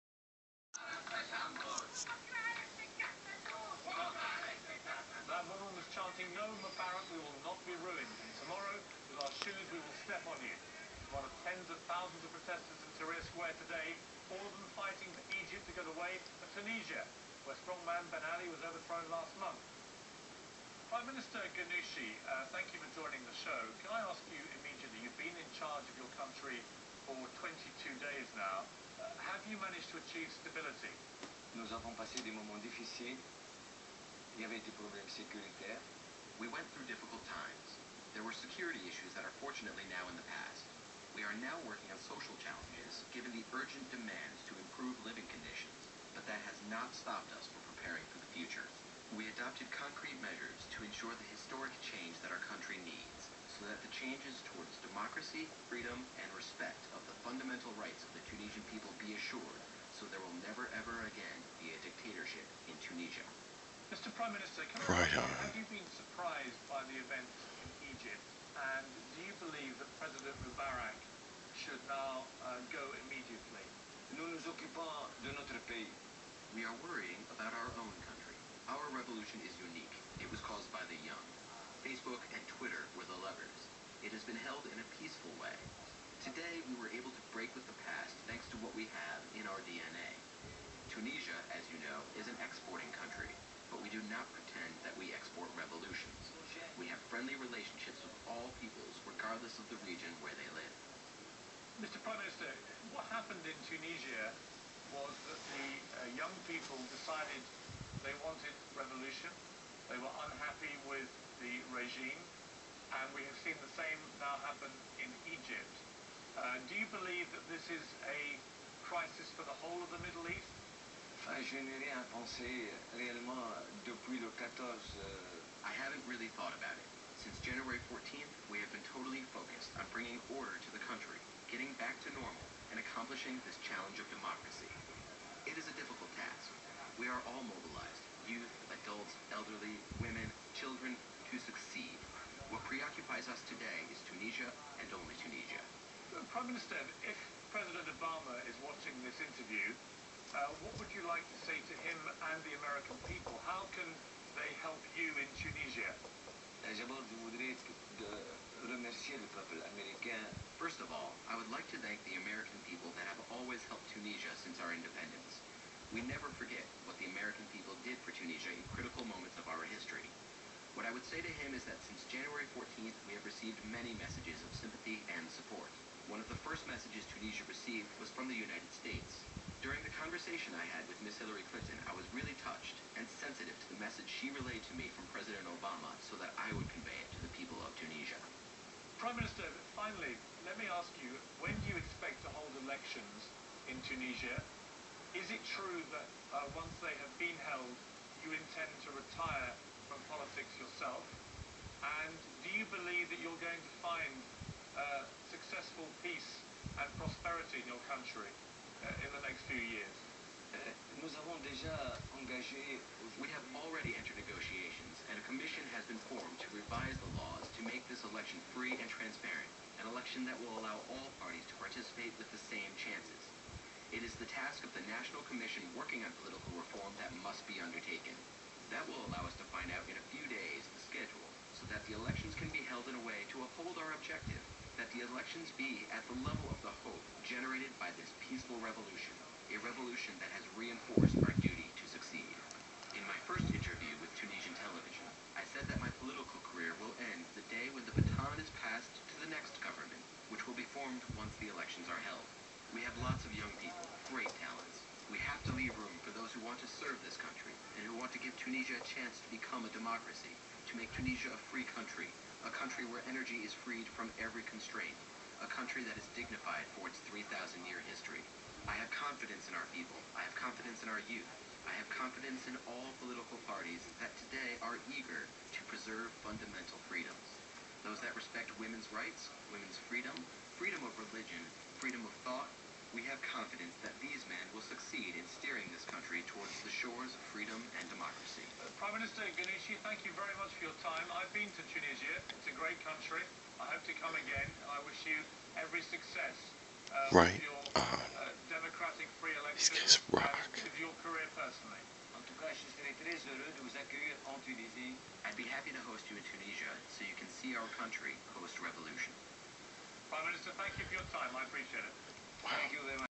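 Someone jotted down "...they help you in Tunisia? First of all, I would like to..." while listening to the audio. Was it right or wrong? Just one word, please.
right.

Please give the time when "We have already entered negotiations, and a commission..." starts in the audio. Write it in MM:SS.
03:33.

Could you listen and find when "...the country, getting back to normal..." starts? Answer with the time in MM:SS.
02:10.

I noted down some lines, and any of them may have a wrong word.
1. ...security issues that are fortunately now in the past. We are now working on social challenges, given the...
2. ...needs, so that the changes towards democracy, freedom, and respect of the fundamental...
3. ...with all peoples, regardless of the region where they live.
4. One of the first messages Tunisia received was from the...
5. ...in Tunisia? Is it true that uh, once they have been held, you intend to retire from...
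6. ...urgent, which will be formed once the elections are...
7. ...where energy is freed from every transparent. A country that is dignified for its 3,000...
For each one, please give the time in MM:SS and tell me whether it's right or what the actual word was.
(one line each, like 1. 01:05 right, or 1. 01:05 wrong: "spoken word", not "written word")
1. 00:38 right
2. 00:52 right
3. 01:38 right
4. 02:56 right
5. 03:13 right
6. 04:09 wrong: "government", not "urgent"
7. 04:22 wrong: "constraint", not "transparent".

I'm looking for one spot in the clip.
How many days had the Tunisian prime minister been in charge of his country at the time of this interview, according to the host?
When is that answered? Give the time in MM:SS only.
00:27.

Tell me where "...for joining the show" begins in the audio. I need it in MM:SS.
00:22.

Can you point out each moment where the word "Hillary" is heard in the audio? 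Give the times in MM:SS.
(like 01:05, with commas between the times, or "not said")
03:01.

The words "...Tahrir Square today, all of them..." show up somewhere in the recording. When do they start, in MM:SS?
00:13.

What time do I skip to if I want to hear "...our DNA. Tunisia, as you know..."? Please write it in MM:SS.
01:29.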